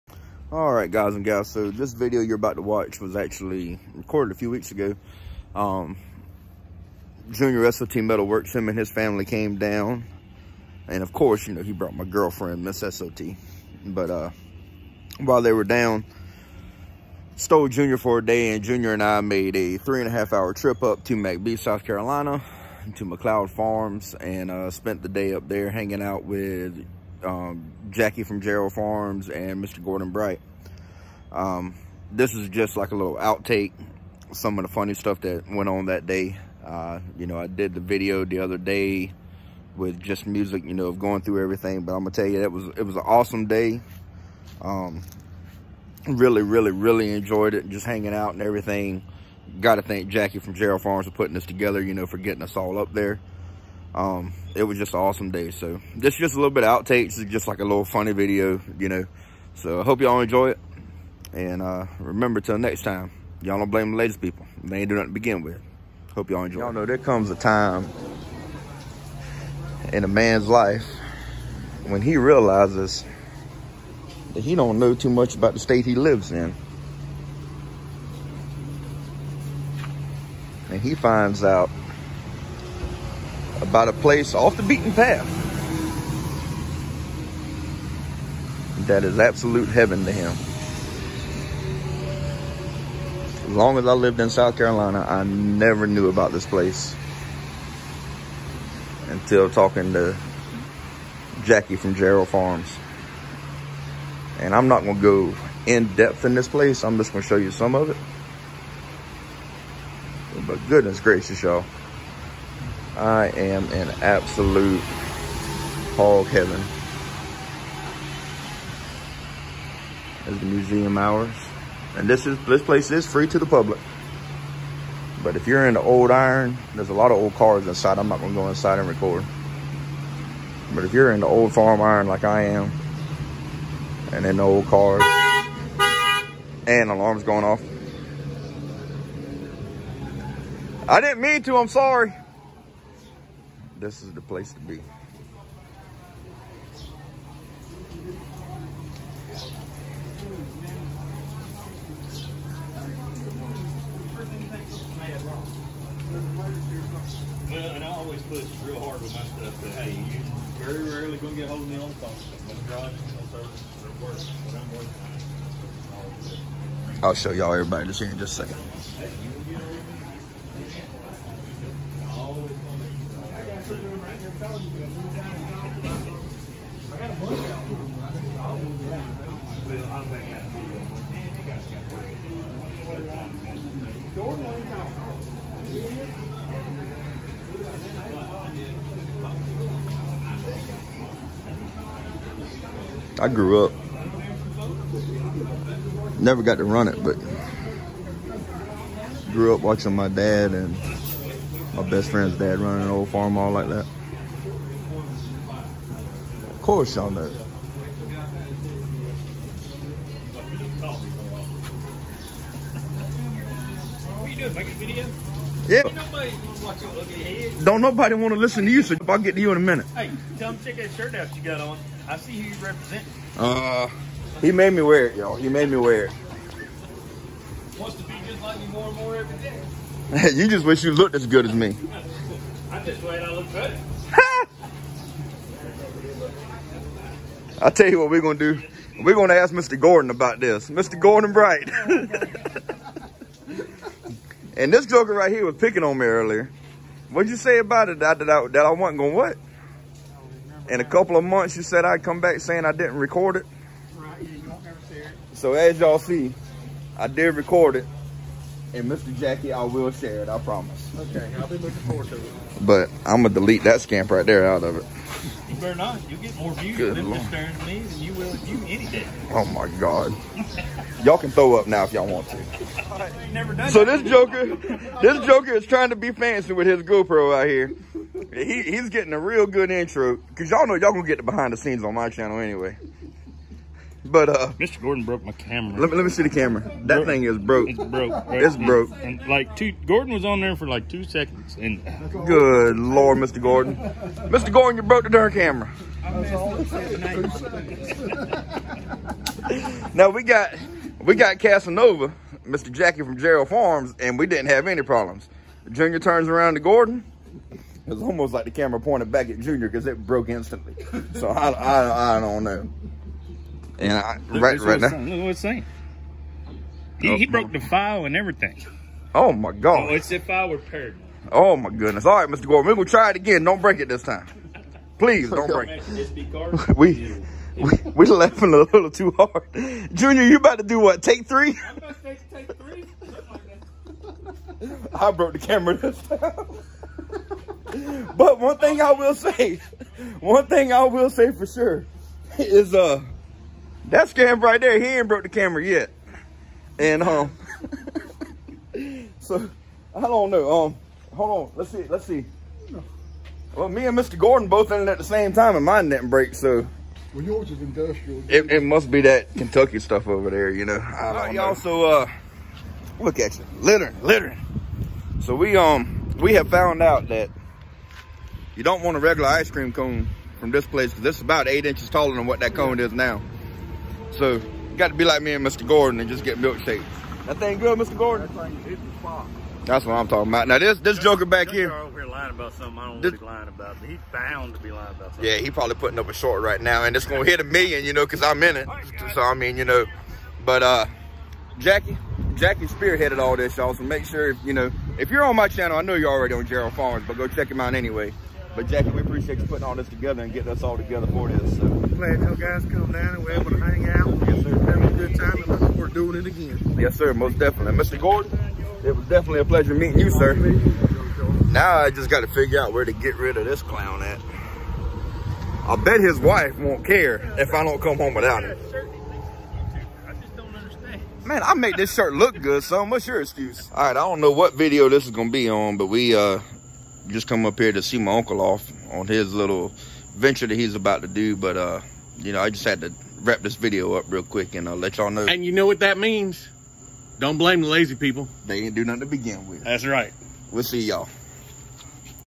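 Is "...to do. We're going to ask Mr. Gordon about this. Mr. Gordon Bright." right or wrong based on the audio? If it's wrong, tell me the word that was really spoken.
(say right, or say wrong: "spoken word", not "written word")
right.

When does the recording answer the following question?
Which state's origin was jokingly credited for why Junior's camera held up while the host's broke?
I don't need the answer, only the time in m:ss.
5:59.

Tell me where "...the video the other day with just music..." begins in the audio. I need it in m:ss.
0:37.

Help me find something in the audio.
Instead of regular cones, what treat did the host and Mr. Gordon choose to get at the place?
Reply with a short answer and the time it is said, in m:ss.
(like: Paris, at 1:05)
Milkshakes, at 6:16.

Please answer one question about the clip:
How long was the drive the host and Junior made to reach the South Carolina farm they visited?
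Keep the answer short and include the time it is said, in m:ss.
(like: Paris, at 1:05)
3.5 hours, at 0:19.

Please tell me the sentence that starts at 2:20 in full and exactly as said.
I didn't mean to, I'm sorry this is the place to be.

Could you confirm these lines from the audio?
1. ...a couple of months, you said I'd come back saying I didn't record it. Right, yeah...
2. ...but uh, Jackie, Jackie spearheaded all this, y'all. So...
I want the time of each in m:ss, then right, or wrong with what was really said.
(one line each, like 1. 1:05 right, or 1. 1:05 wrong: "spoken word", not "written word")
1. 4:10 right
2. 6:30 right.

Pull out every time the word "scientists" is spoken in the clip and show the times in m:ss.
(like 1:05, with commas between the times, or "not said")
not said.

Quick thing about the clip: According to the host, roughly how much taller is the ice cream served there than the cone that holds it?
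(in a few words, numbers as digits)
8 inches.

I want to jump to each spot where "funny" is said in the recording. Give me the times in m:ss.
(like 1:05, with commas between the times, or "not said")
0:34, 0:57.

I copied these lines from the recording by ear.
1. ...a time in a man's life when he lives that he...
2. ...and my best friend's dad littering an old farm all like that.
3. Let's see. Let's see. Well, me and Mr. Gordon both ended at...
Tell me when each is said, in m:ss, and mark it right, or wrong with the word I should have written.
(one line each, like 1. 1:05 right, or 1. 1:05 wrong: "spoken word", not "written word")
1. 1:07 wrong: "realizes", not "lives"
2. 3:20 wrong: "running", not "littering"
3. 5:51 right.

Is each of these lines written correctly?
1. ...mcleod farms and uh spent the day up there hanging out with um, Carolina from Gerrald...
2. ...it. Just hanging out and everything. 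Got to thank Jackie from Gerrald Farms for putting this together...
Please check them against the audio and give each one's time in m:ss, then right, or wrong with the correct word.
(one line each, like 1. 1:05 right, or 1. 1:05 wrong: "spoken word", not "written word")
1. 0:23 wrong: "Jackie", not "Carolina"
2. 0:47 right.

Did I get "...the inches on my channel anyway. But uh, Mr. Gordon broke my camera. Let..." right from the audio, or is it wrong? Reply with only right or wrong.
wrong.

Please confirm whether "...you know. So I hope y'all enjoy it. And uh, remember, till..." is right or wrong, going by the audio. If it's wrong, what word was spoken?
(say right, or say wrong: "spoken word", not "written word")
right.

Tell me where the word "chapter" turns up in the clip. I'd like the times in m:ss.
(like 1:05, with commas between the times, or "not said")
not said.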